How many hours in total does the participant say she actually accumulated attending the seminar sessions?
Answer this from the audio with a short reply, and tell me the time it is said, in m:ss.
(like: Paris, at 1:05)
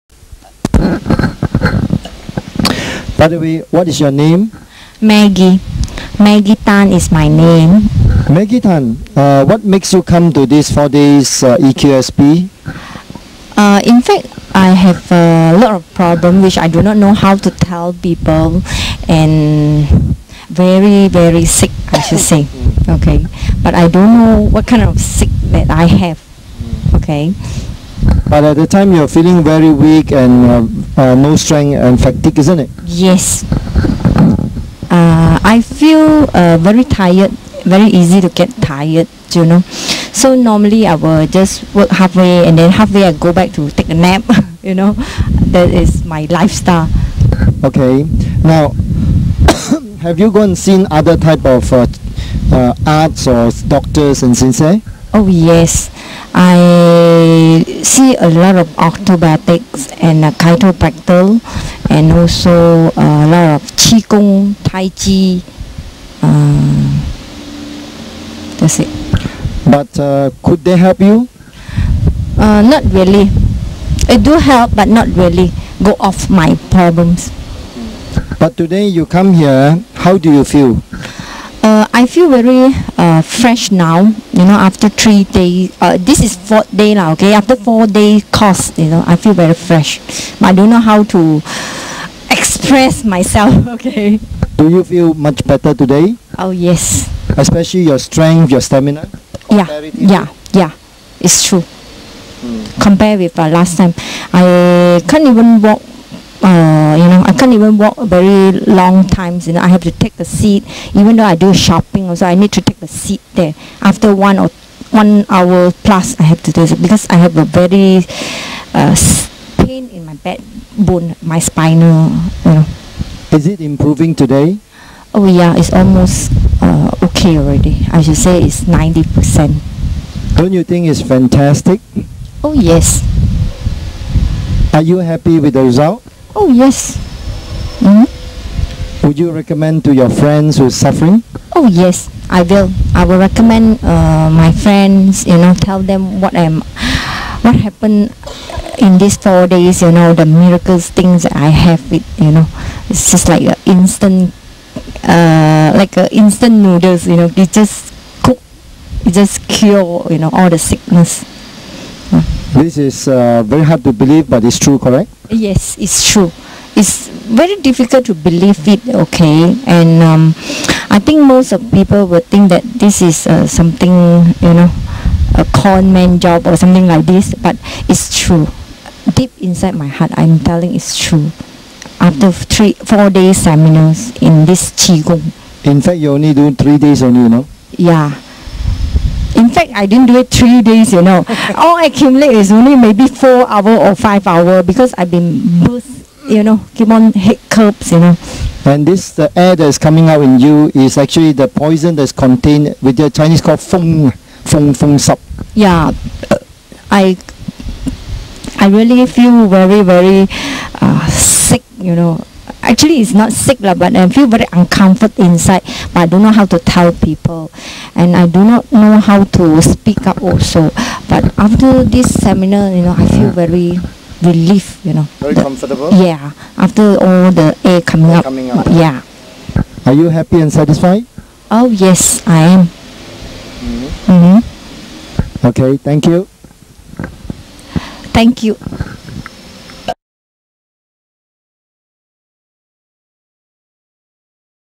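4 or 5 hours, at 3:13.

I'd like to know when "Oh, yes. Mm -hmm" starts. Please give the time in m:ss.
2:16.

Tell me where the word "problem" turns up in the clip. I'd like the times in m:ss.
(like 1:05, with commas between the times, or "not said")
0:15, 1:16.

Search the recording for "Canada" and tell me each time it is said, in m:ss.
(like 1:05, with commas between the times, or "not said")
not said.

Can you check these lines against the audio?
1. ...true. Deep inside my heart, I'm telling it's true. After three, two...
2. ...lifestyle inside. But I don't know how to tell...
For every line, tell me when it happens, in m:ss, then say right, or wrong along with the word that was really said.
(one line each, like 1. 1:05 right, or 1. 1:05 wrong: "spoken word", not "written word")
1. 2:58 wrong: "four", not "two"
2. 3:34 wrong: "uncomfortable", not "lifestyle".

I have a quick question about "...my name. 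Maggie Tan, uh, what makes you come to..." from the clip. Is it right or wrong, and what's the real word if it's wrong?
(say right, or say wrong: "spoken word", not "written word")
right.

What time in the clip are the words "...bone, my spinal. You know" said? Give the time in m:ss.
2:00.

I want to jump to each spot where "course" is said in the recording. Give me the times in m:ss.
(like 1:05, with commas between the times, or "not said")
1:28.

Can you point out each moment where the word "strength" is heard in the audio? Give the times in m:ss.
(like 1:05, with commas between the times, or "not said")
0:31, 1:37.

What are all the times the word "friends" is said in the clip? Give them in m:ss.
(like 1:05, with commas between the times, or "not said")
2:20, 2:24.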